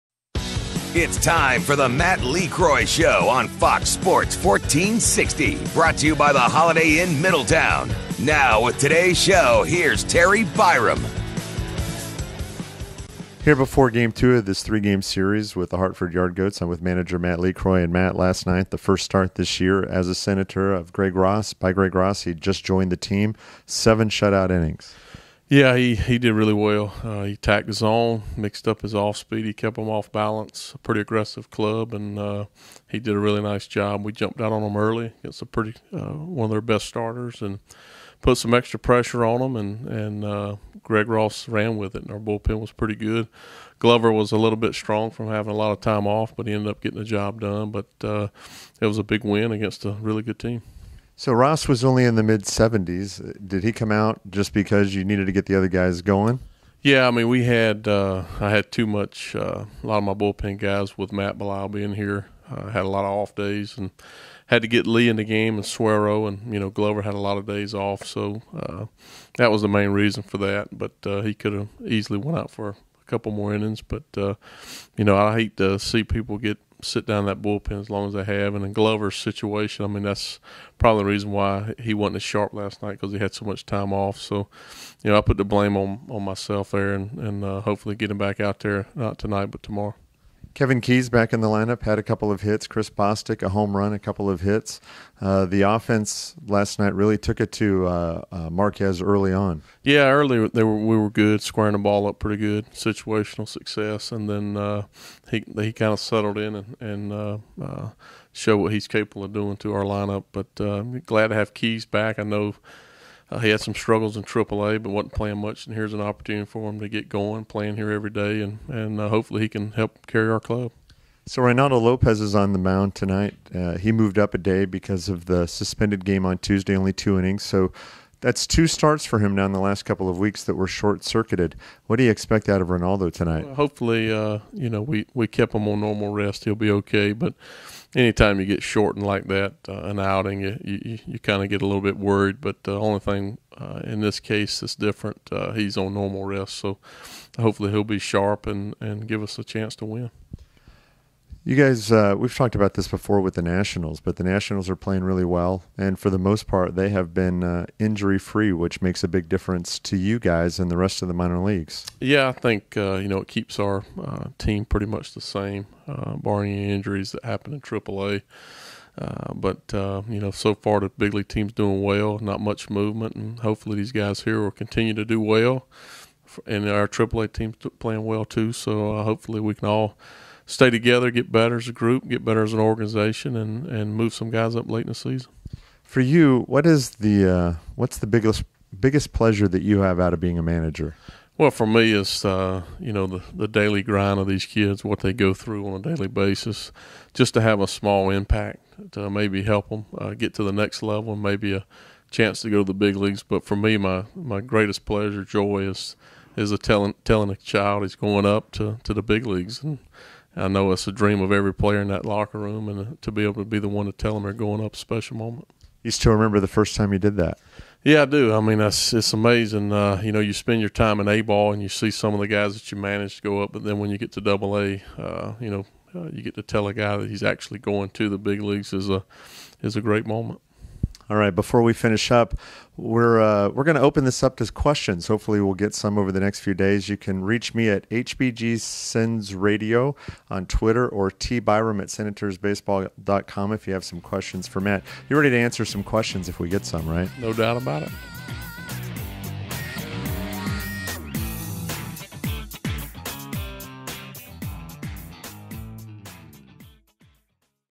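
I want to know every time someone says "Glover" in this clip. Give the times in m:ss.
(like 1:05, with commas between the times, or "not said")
0:43, 1:06, 1:18.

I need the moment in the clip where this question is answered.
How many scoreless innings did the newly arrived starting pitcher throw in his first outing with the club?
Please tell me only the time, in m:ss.
0:23.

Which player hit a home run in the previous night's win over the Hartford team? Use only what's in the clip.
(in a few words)
Chris Bostick.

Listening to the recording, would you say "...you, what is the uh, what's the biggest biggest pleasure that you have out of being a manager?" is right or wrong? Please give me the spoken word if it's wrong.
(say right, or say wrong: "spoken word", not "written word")
right.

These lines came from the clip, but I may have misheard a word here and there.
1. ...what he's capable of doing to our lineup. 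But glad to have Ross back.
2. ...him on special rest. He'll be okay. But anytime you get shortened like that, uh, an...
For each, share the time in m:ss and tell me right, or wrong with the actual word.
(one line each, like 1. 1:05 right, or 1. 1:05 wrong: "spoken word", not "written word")
1. 1:48 wrong: "Keys", not "Ross"
2. 2:15 wrong: "normal", not "special".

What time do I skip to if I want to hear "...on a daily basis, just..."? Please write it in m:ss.
3:15.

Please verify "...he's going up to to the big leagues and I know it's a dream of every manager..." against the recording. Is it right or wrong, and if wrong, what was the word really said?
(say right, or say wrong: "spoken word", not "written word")
wrong: "player", not "manager".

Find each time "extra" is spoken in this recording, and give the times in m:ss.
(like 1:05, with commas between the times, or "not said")
0:38.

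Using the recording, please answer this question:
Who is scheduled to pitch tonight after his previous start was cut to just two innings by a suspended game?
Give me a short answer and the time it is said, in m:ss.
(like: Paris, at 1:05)
Reynaldo Lopez, at 2:01.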